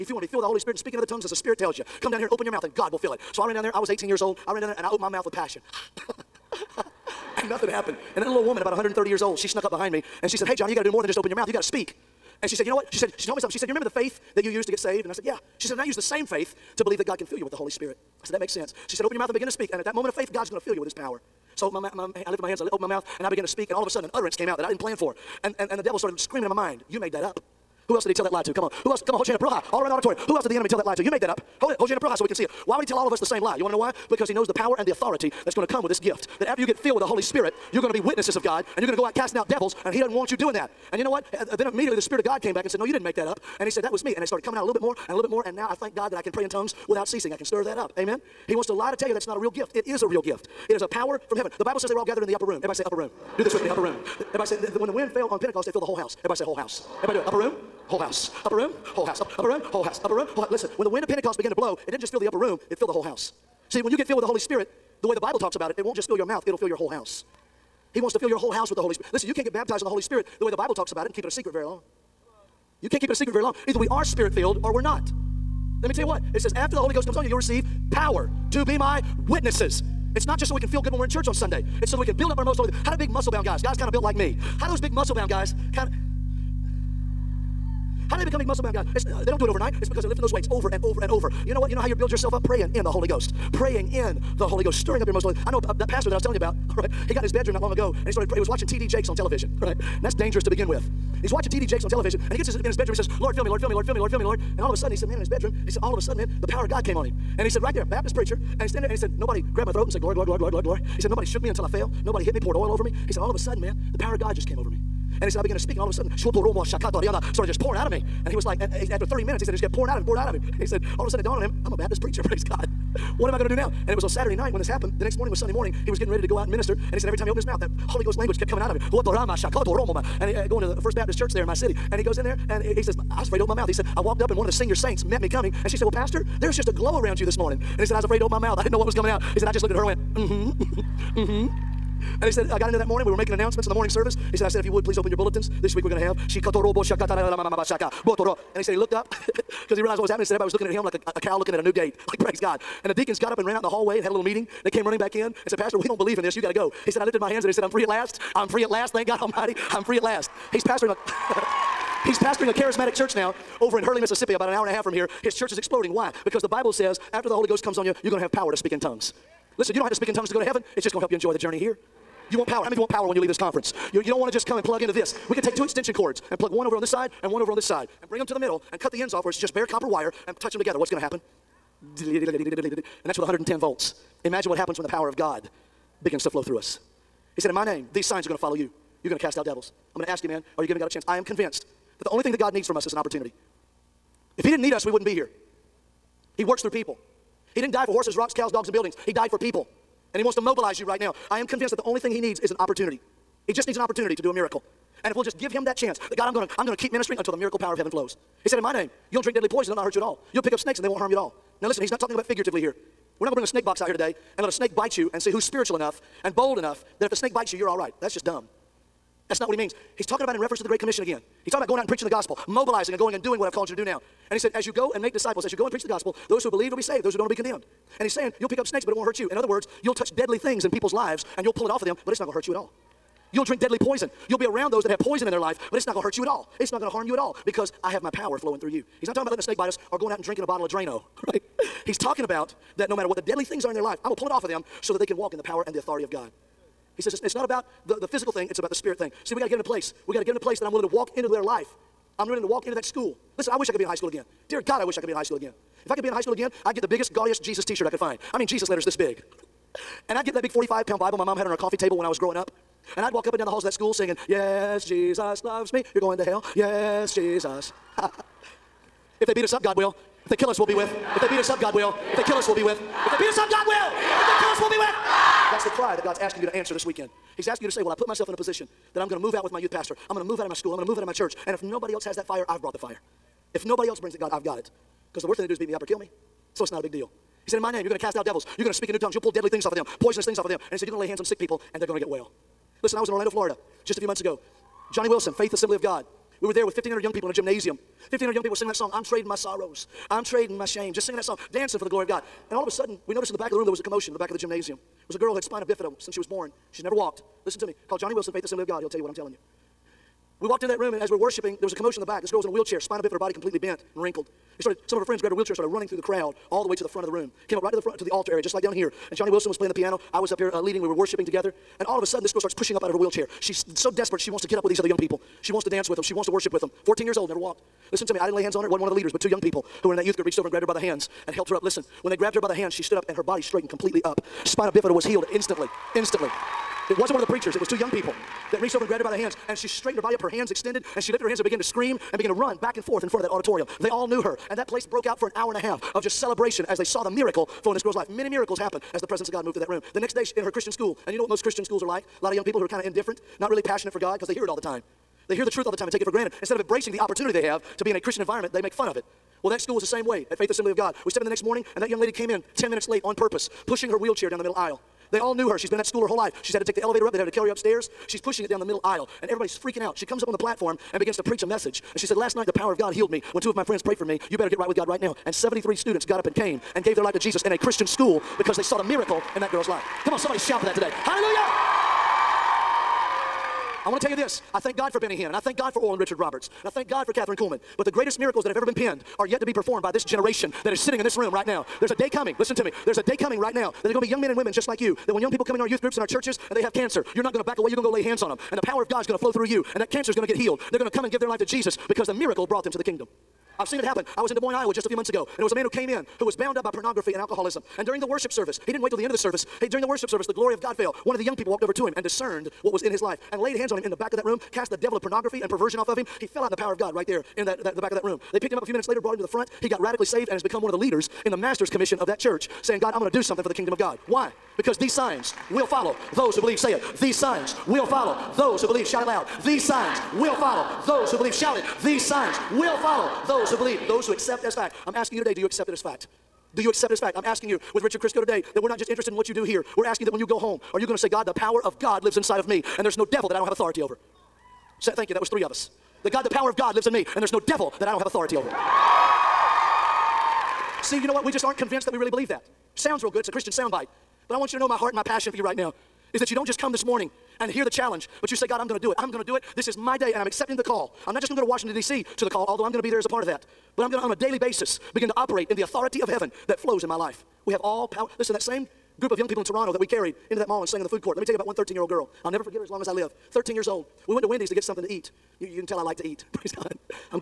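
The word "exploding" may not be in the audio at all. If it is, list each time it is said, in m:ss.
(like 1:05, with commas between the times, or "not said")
2:45.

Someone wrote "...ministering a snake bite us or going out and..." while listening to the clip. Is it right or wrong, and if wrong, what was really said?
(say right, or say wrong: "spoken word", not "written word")
wrong: "letting", not "ministering".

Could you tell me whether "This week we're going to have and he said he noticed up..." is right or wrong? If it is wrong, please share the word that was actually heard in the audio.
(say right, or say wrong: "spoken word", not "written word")
wrong: "looked", not "noticed".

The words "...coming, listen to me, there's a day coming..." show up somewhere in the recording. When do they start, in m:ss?
6:32.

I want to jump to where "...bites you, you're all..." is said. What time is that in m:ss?
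3:37.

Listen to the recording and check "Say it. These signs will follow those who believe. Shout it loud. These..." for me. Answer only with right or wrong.
right.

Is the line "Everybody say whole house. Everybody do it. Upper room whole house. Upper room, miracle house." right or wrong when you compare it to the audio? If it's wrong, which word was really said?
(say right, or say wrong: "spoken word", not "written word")
wrong: "whole", not "miracle".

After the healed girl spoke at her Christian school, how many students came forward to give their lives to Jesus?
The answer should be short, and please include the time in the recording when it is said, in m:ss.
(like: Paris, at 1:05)
73, at 6:15.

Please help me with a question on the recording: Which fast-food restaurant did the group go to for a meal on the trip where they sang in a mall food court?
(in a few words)
Wendy's.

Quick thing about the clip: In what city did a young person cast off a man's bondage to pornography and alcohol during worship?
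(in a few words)
Des Moines, Iowa.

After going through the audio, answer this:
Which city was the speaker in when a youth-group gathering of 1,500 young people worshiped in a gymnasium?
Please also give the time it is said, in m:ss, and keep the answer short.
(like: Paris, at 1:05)
Orlando, Florida, at 4:53.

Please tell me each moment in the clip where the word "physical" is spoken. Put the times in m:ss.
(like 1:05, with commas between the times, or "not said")
4:08.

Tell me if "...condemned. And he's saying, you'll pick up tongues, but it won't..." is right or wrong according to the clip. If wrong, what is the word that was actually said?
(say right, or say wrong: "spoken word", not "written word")
wrong: "snakes", not "tongues".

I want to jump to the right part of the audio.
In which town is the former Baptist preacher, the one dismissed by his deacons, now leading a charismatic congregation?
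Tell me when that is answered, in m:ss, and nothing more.
2:43.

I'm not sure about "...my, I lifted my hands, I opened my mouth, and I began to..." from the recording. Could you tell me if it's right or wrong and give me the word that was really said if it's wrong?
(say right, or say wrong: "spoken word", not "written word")
right.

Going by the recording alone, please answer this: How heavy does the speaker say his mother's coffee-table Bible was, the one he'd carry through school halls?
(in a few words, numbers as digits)
45 pounds.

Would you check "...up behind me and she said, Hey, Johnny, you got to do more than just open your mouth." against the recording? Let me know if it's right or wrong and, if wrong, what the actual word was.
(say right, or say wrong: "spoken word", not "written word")
right.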